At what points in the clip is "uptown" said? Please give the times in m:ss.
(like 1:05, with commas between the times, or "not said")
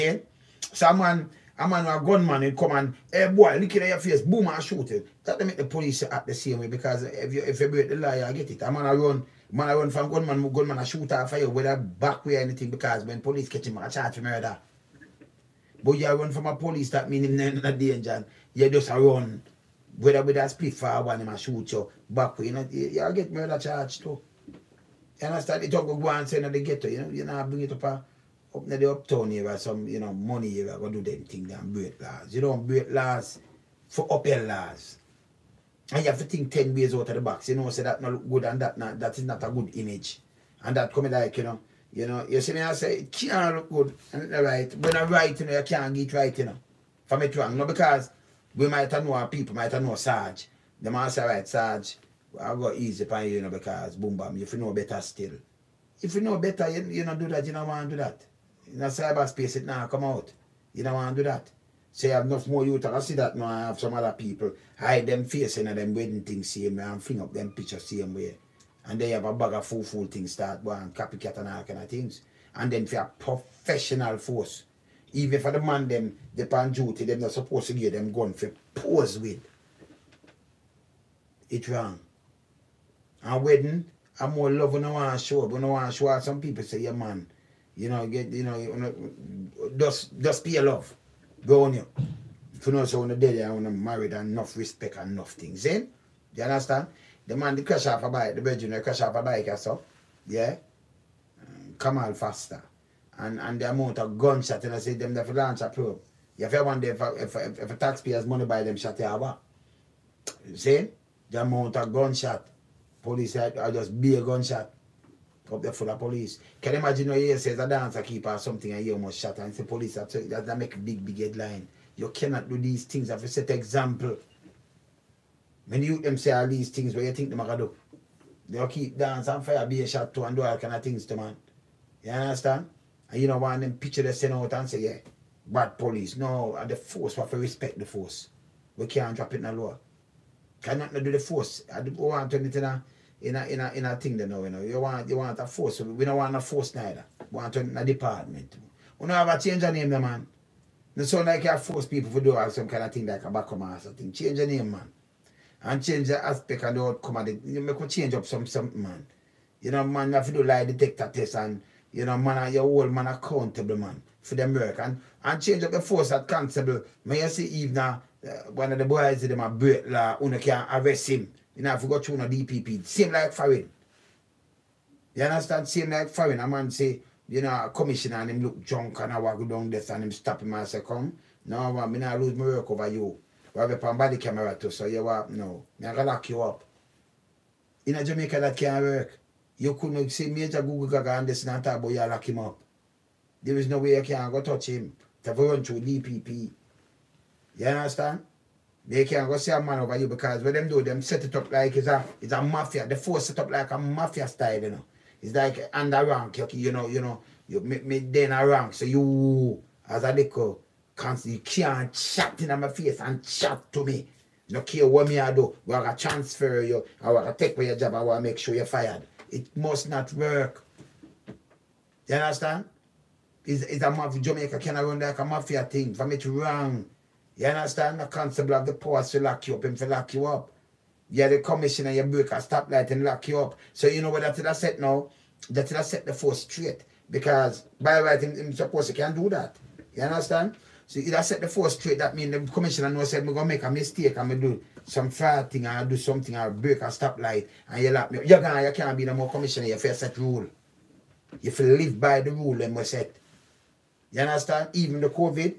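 0:28.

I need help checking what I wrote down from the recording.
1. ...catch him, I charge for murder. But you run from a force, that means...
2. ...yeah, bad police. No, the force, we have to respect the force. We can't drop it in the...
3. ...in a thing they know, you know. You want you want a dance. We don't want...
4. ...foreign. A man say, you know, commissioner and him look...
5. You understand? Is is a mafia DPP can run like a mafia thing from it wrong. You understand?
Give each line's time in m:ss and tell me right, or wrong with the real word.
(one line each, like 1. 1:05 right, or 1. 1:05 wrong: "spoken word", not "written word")
1. 0:13 wrong: "police", not "force"
2. 2:14 right
3. 2:23 wrong: "force", not "dance"
4. 2:56 right
5. 3:42 wrong: "Jamaica", not "DPP".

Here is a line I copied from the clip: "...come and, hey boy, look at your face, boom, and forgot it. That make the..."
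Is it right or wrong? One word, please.
wrong.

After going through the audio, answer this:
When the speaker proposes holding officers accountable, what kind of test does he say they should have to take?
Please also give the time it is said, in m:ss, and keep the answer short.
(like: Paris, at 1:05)
lie detector test, at 2:40.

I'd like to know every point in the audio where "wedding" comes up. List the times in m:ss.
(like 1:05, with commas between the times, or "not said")
1:05, 1:23.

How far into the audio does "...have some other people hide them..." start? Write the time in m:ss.
1:03.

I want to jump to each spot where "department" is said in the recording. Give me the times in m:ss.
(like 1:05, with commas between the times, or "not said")
2:27.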